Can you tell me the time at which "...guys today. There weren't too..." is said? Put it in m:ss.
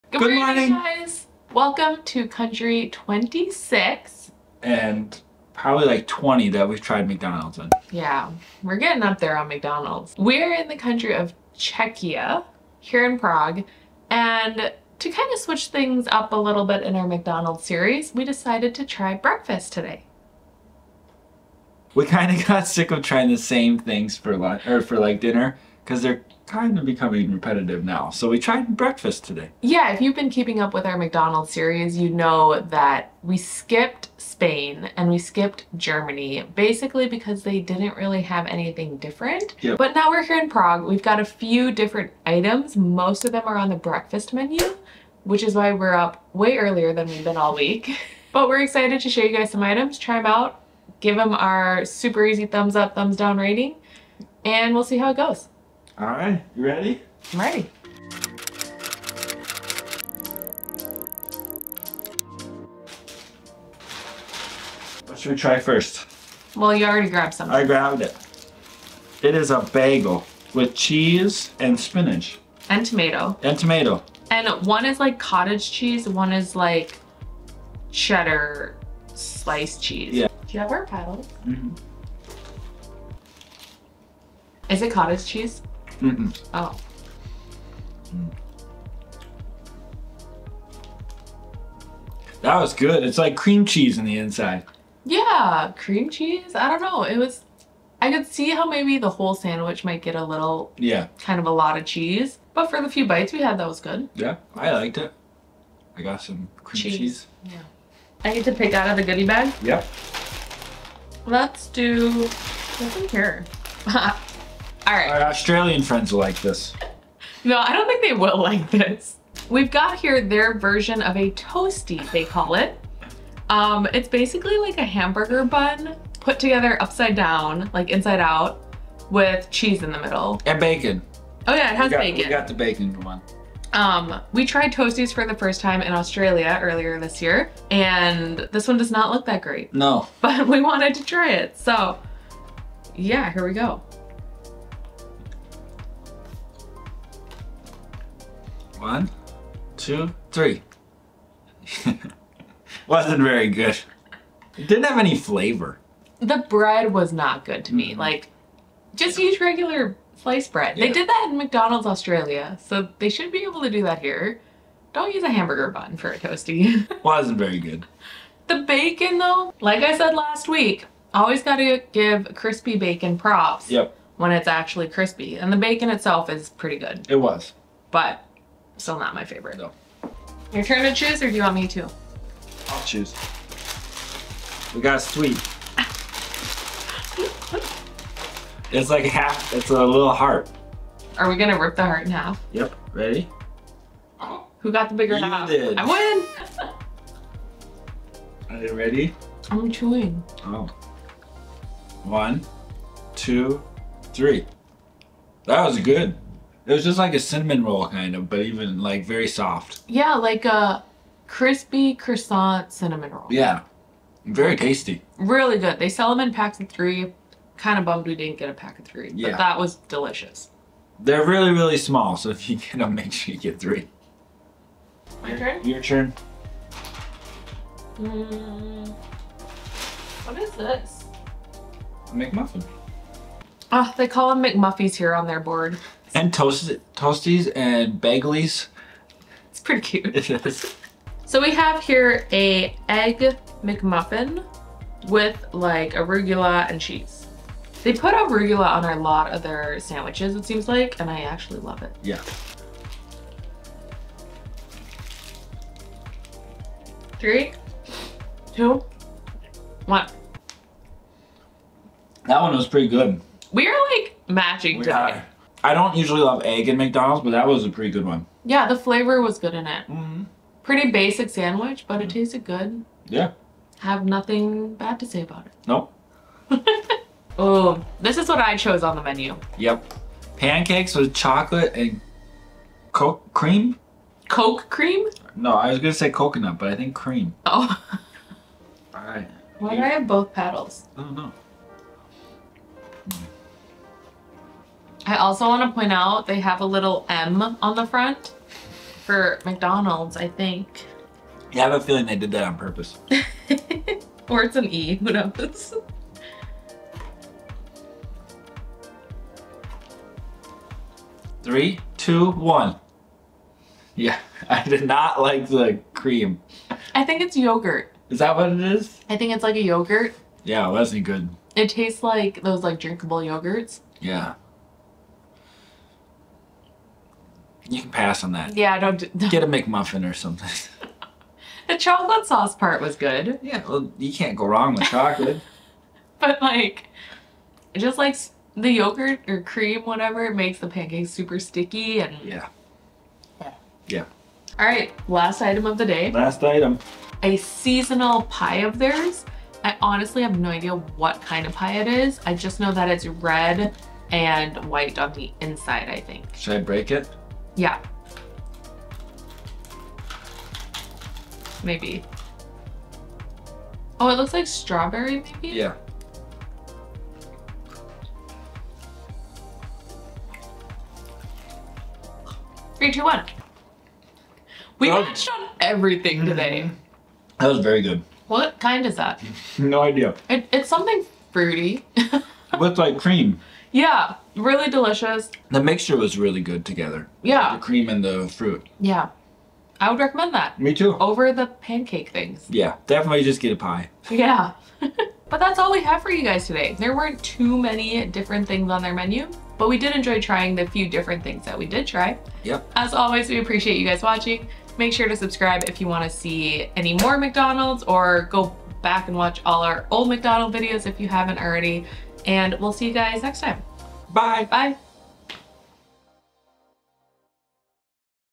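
6:36.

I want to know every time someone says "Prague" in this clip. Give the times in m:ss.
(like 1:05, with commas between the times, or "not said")
0:13, 0:40.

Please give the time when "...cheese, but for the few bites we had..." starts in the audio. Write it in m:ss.
1:41.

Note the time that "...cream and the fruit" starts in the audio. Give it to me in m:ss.
6:27.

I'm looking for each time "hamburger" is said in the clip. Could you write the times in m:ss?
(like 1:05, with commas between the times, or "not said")
2:04, 2:45.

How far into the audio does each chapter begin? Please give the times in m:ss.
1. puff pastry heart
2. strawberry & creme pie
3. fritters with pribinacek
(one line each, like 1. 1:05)
1. 3:04
2. 5:46
3. 4:39.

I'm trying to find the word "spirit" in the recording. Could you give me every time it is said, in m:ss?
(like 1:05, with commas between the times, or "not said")
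not said.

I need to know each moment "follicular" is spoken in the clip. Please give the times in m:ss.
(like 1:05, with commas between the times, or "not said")
not said.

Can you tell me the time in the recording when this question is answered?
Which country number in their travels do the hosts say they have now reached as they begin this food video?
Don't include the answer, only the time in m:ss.
0:02.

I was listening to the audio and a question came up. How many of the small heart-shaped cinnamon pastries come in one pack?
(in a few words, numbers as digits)
3.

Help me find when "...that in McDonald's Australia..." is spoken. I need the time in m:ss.
2:41.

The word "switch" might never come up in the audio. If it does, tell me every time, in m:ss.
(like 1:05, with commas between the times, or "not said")
0:15.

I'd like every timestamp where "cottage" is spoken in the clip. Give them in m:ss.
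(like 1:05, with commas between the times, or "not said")
1:15, 1:24.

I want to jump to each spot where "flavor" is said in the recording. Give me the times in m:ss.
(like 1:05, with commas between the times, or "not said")
2:35, 4:28.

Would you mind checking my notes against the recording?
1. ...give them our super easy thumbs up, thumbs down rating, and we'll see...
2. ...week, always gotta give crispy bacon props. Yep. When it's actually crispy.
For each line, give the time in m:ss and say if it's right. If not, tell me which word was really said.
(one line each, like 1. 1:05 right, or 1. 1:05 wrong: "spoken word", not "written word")
1. 0:51 right
2. 2:50 right.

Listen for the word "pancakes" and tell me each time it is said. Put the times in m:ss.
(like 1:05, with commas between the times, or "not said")
4:40, 5:40, 6:31.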